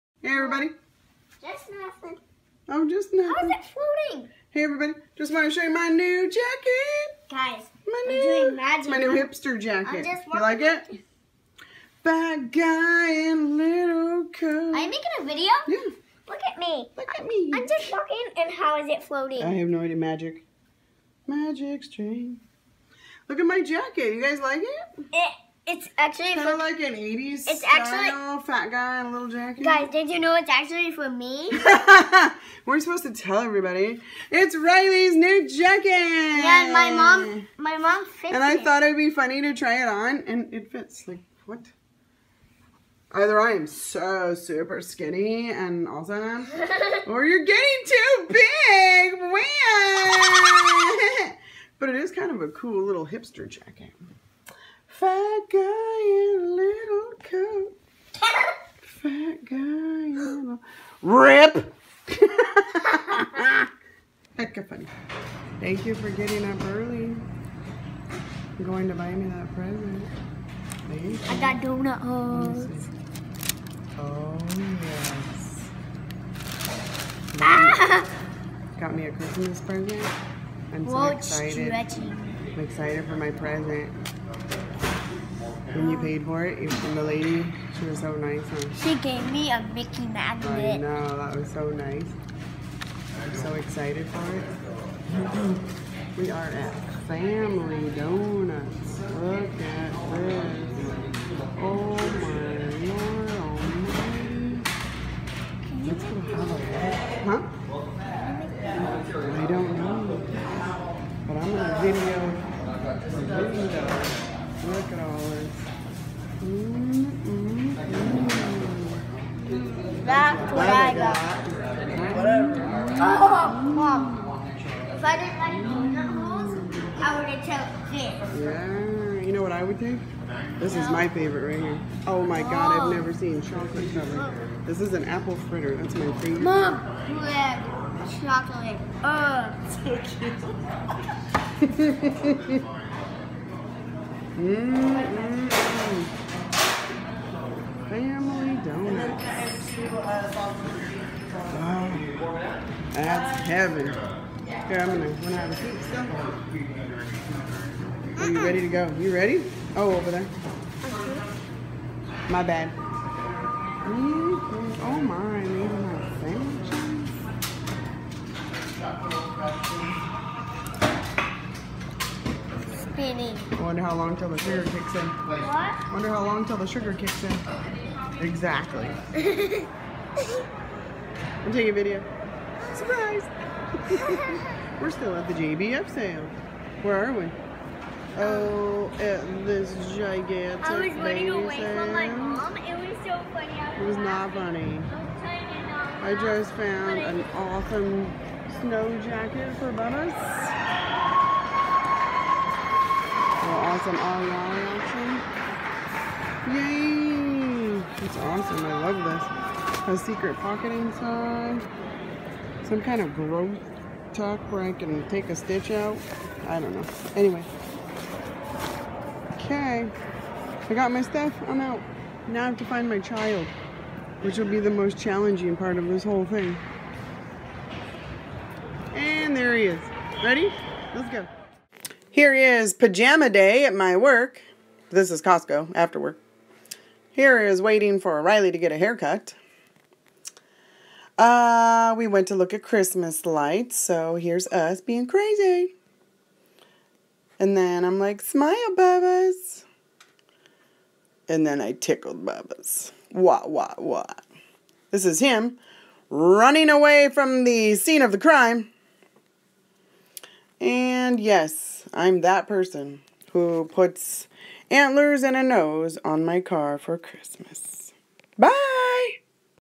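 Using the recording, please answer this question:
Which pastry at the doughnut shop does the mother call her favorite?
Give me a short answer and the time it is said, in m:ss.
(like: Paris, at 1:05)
apple fritter, at 2:15.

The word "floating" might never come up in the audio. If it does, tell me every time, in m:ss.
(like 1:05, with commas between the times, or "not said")
0:03, 0:19.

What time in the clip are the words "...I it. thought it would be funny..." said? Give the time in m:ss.
0:38.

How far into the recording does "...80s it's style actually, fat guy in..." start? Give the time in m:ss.
0:26.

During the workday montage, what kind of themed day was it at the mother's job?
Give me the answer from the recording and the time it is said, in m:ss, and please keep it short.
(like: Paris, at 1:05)
pajama day, at 3:52.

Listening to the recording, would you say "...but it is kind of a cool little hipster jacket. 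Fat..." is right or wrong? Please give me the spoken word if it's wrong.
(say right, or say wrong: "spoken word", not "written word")
right.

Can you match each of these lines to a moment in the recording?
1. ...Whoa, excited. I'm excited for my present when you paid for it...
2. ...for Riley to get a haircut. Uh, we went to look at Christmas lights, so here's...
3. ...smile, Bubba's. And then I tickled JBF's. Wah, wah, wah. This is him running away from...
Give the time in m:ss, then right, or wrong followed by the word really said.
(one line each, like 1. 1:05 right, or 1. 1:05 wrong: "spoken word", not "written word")
1. 1:20 right
2. 3:57 right
3. 4:08 wrong: "Bubba", not "JBF".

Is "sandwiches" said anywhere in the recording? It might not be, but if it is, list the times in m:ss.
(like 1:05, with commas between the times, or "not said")
2:52.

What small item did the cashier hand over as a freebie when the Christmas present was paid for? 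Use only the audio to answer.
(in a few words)
Mickey magnet.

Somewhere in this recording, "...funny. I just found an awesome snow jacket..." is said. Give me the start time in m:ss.
3:15.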